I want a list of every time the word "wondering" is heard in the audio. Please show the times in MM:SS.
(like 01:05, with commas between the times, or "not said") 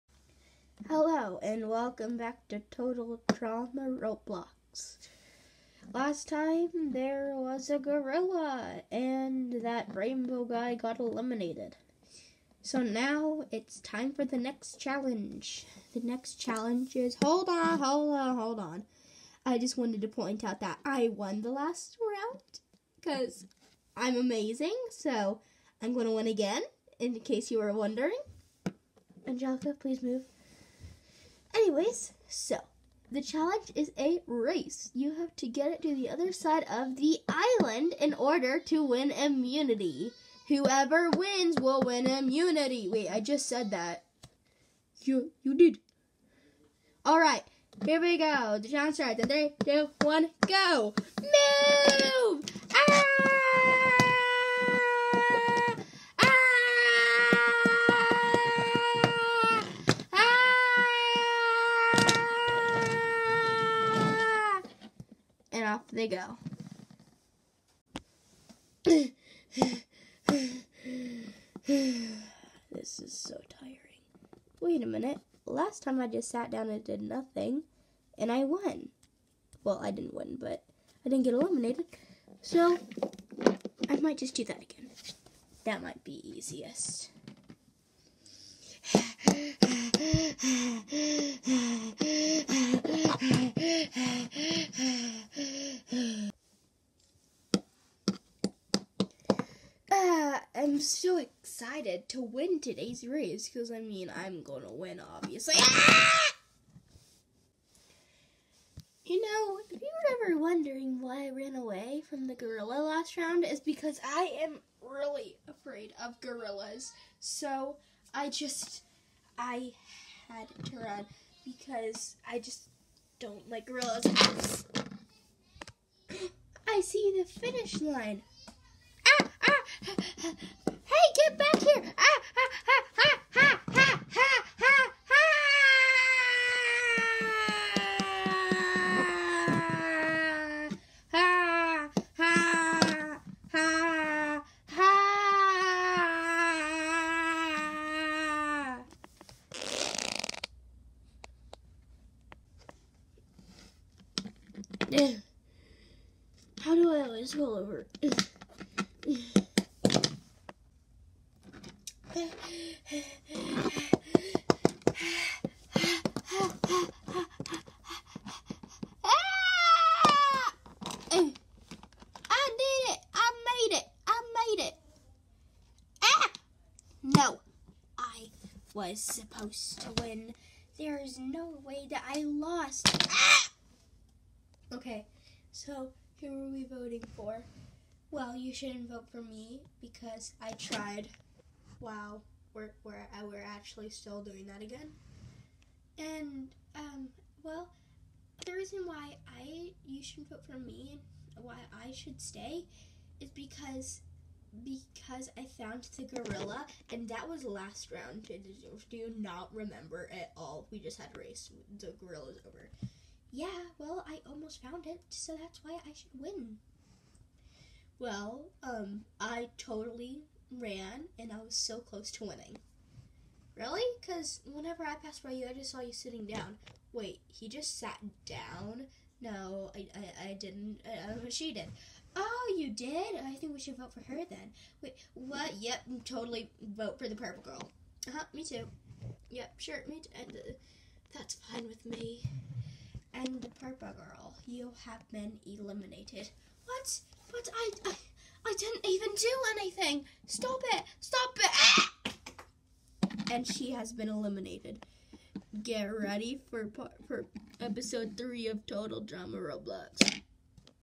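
00:27, 01:50.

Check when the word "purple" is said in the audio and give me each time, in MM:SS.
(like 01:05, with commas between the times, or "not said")
03:57, 04:03.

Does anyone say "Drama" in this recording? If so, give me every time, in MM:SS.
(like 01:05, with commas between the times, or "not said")
00:03, 04:19.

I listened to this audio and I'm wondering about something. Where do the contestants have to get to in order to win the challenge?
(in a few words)
The other side of the island.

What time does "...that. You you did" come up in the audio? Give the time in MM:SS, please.
00:43.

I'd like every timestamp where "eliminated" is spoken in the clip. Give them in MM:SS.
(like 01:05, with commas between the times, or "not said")
00:10, 01:21, 04:05, 04:14.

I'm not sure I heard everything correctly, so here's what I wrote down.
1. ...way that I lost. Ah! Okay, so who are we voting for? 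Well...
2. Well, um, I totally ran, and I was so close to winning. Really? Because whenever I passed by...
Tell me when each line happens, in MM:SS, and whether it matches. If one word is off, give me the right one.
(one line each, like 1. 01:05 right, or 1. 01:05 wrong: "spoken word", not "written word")
1. 03:01 right
2. 03:37 right.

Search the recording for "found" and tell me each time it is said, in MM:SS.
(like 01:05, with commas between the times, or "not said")
03:25, 03:34.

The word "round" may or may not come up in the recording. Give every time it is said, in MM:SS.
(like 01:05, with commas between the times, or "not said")
00:22, 01:53, 03:27.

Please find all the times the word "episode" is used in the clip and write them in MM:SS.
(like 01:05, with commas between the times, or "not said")
04:17.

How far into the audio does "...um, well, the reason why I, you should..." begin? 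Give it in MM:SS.
03:16.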